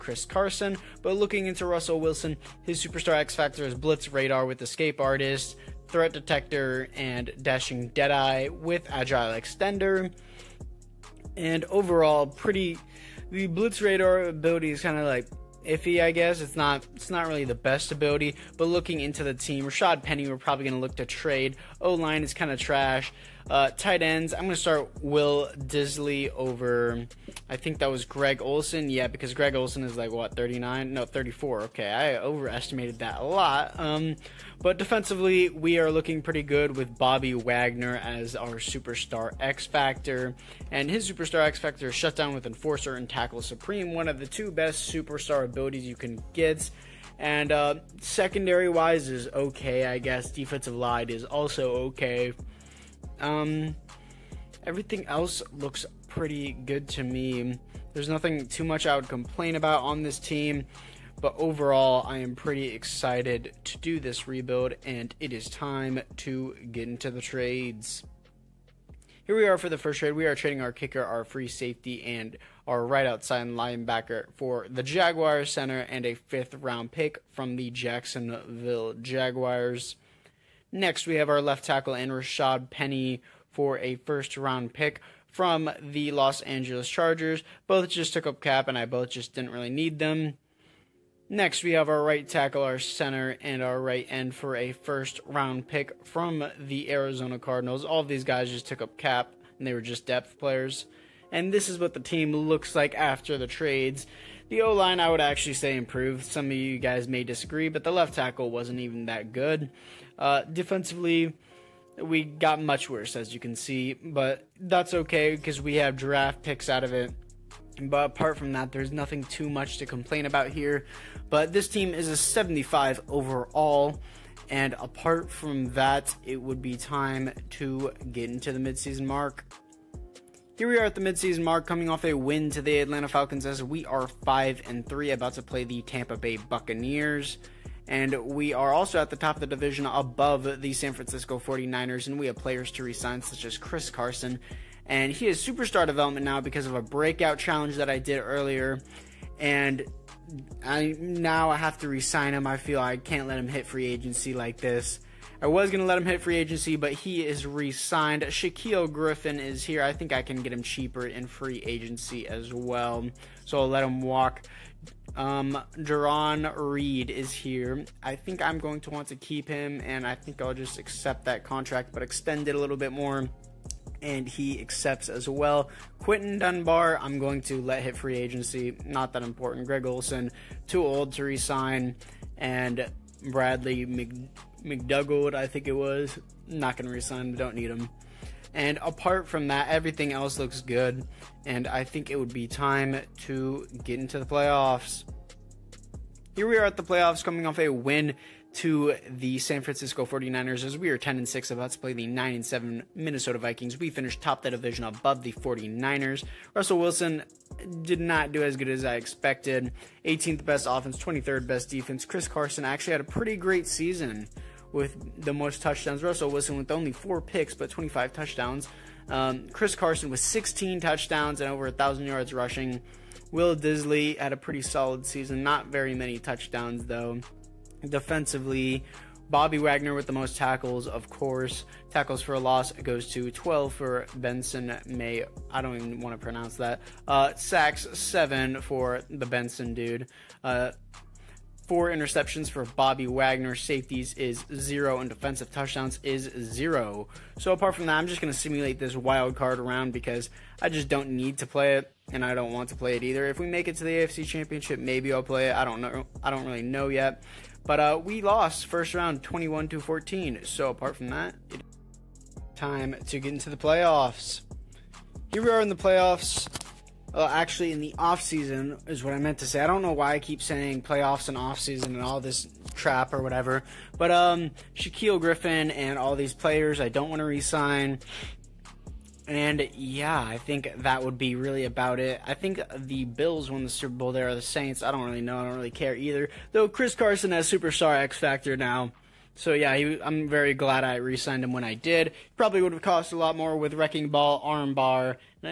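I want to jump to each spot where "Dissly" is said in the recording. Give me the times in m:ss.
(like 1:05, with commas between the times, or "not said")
0:25, 3:43.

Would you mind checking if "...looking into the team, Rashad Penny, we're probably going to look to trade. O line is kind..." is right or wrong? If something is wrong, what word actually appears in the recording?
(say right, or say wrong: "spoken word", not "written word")
right.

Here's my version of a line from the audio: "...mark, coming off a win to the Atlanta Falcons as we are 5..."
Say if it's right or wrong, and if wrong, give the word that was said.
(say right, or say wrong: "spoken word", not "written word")
right.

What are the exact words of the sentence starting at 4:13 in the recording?
If we make it to the AFC Championship, maybe I'll play it.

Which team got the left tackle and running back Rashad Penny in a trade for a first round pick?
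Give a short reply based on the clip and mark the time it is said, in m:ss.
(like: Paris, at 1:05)
Los Angeles Chargers, at 1:26.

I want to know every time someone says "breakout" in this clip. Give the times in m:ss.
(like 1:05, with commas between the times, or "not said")
2:26.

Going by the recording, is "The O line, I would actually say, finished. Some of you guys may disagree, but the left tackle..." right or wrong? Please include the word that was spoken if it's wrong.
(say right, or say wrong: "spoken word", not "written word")
wrong: "improved", not "finished".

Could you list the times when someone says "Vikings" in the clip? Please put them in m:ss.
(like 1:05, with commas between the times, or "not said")
3:23.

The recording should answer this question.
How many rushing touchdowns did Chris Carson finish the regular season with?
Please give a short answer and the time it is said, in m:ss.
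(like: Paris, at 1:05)
16, at 3:40.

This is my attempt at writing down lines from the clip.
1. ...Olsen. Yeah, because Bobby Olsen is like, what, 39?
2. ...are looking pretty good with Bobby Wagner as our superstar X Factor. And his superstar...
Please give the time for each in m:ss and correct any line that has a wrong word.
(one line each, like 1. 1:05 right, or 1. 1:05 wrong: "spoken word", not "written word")
1. 0:28 wrong: "Greg", not "Bobby"
2. 0:35 right.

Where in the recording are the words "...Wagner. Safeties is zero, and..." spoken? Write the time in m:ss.
4:03.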